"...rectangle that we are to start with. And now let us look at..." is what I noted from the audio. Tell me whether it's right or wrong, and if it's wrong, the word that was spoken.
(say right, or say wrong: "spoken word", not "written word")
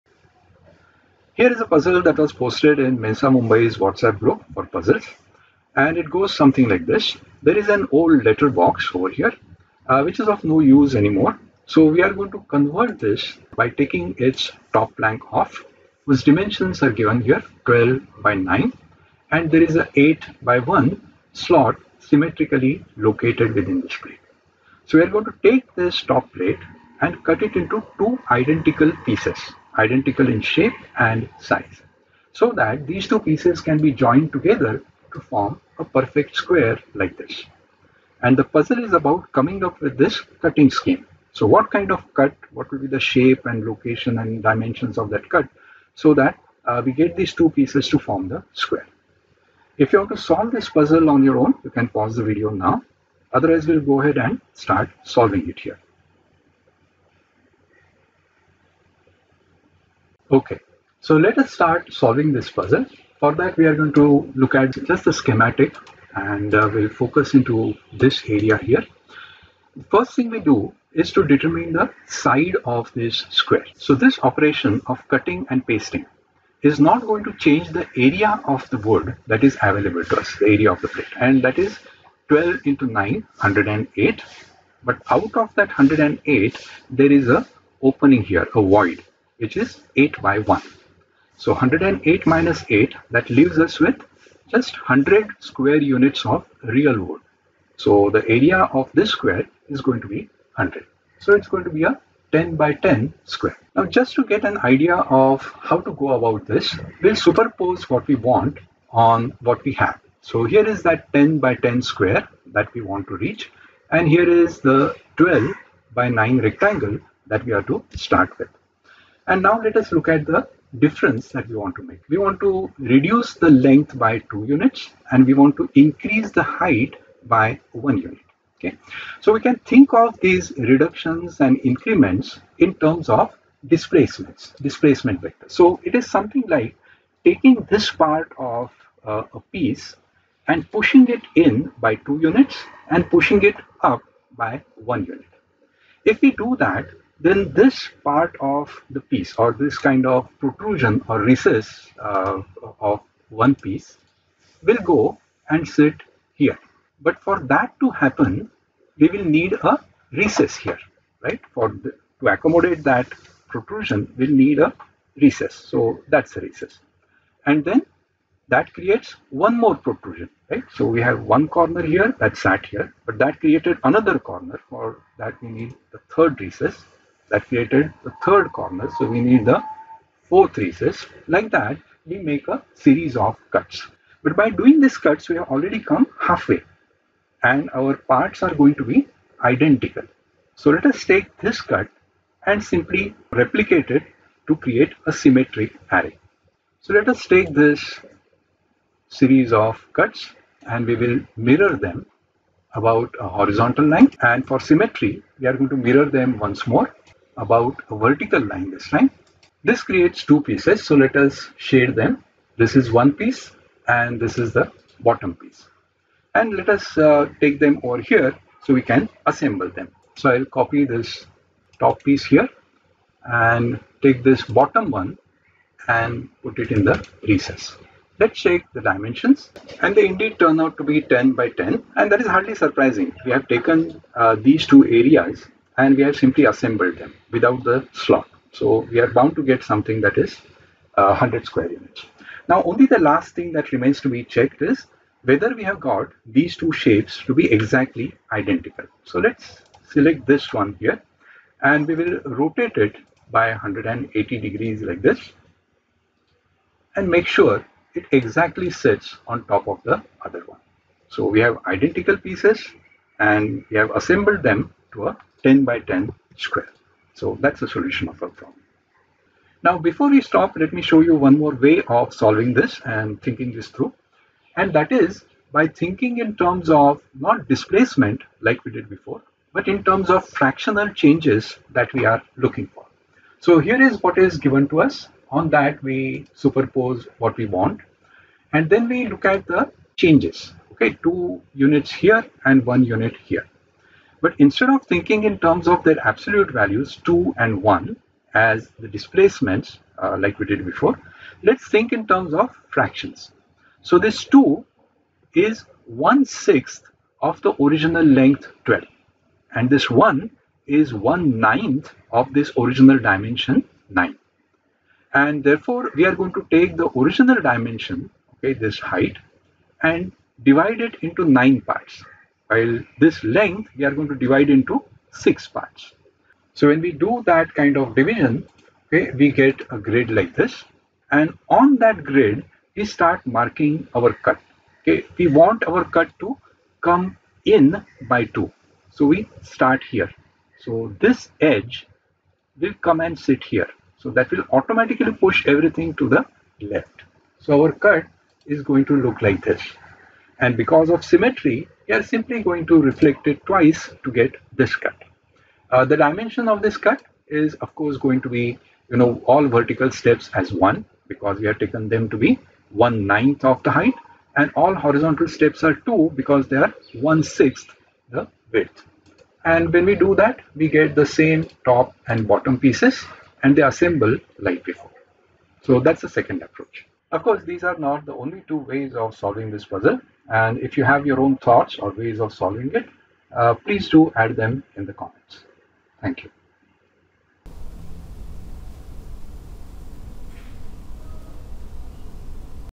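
right.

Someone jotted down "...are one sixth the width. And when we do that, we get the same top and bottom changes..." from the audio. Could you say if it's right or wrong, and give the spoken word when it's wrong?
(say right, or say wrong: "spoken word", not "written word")
wrong: "pieces", not "changes".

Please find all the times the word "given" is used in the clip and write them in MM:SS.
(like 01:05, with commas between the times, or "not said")
00:16, 04:44.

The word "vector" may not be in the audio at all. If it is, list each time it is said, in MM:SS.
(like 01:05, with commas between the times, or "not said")
02:15.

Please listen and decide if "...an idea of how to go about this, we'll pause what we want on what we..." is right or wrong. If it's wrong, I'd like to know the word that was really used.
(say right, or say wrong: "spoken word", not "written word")
wrong: "superpose", not "pause".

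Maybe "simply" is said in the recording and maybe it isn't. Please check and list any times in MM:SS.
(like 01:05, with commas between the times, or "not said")
03:12, 03:56, 05:52.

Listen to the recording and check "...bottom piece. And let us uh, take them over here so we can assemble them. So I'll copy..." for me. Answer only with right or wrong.
right.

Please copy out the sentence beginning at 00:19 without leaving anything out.
And there is a 8 by 1 slot symmetrically located within this plate.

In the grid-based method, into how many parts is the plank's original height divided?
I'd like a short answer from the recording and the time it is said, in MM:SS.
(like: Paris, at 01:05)
9, at 05:21.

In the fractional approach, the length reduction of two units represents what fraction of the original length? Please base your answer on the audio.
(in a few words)
1/6.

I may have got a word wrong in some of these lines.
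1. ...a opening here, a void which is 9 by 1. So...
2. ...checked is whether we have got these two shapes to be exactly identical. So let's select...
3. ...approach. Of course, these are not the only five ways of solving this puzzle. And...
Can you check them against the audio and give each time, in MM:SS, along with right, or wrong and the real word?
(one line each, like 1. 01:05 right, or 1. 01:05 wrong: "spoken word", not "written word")
1. 01:27 wrong: "8", not "9"
2. 04:04 right
3. 06:16 wrong: "two", not "five".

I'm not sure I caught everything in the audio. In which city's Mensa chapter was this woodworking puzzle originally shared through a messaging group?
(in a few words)
Mumbai.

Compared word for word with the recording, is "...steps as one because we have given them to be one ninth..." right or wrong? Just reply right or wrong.
wrong.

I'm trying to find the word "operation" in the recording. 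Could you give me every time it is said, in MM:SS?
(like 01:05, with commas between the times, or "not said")
01:14.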